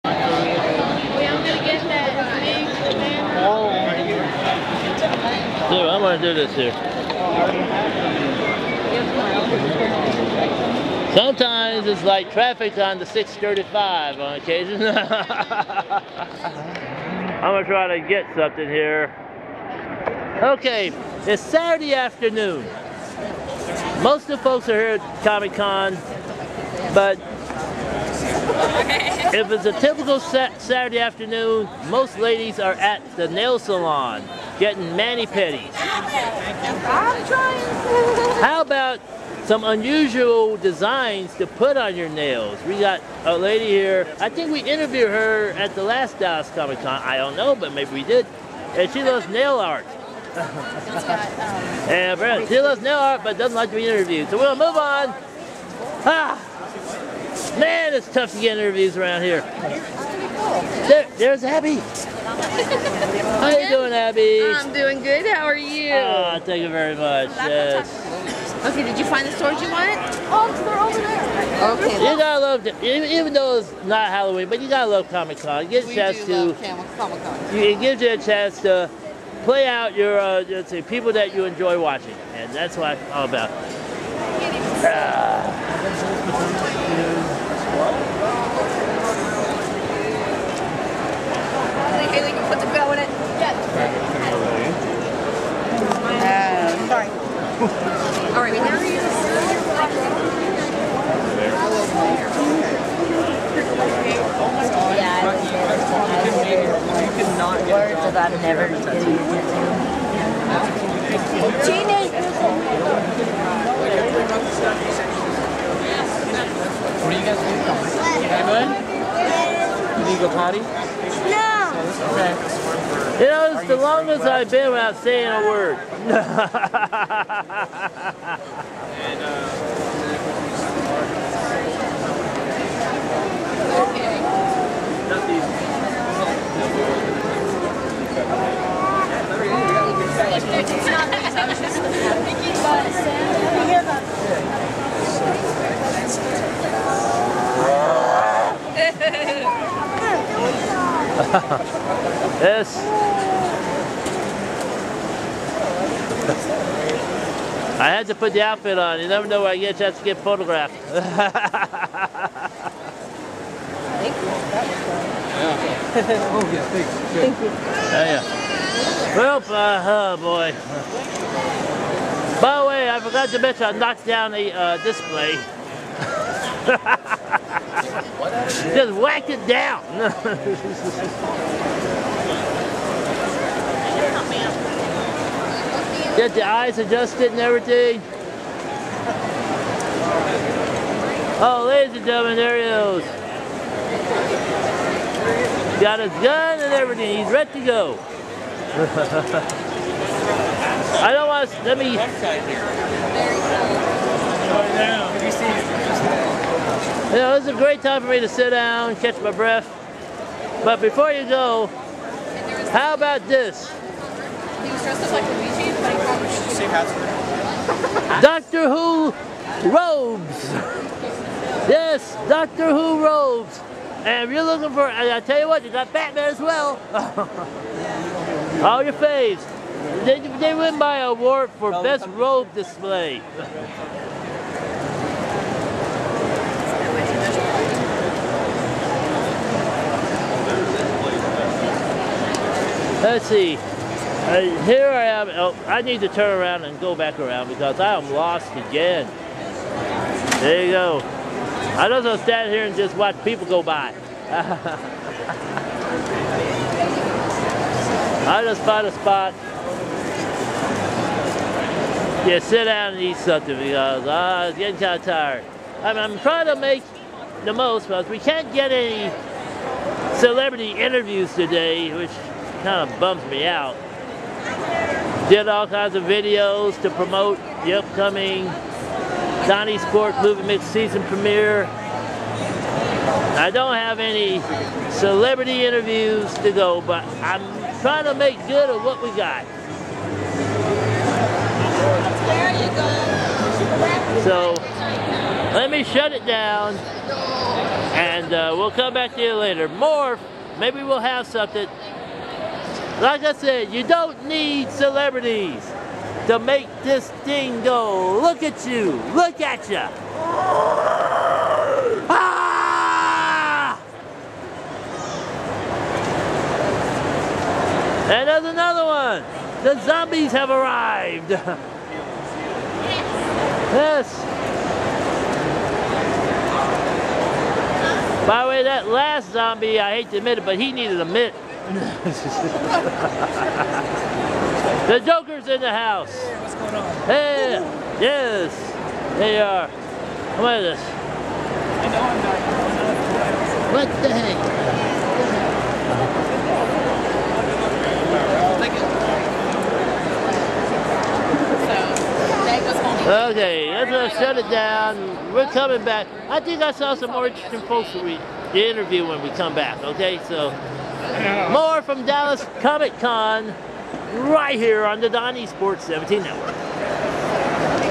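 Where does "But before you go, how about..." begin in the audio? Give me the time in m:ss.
3:30.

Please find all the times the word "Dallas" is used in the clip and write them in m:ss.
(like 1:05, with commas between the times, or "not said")
0:46, 6:02.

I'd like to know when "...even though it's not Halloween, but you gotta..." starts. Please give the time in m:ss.
1:12.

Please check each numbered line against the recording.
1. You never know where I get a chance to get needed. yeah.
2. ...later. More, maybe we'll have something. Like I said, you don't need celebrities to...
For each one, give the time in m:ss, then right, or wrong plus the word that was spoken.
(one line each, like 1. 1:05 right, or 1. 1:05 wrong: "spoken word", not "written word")
1. 2:38 wrong: "photographed", not "needed"
2. 4:59 right.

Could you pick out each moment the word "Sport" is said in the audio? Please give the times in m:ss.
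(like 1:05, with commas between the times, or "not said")
4:39, 6:05.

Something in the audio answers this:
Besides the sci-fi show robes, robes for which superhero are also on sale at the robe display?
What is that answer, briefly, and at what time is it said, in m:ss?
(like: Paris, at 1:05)
Batman, at 3:45.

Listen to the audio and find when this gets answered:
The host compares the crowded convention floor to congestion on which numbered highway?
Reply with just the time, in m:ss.
0:13.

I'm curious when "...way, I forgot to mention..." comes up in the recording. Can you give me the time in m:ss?
2:52.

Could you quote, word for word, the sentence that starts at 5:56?
I think I saw some interesting folks we interview when we come back, okay?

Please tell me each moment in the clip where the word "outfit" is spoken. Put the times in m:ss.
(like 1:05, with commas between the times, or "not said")
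2:38.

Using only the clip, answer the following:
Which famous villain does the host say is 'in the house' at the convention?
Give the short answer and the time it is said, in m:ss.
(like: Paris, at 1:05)
The Joker, at 5:35.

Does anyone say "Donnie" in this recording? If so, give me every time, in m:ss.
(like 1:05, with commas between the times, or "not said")
4:39, 6:05.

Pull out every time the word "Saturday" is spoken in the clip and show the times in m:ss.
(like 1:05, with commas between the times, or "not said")
0:21, 0:30.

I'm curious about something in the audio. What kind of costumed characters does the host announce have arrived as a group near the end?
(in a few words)
zombies.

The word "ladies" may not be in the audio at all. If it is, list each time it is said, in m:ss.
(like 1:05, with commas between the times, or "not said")
0:32, 3:11.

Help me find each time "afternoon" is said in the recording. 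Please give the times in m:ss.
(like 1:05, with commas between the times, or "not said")
0:21, 0:30.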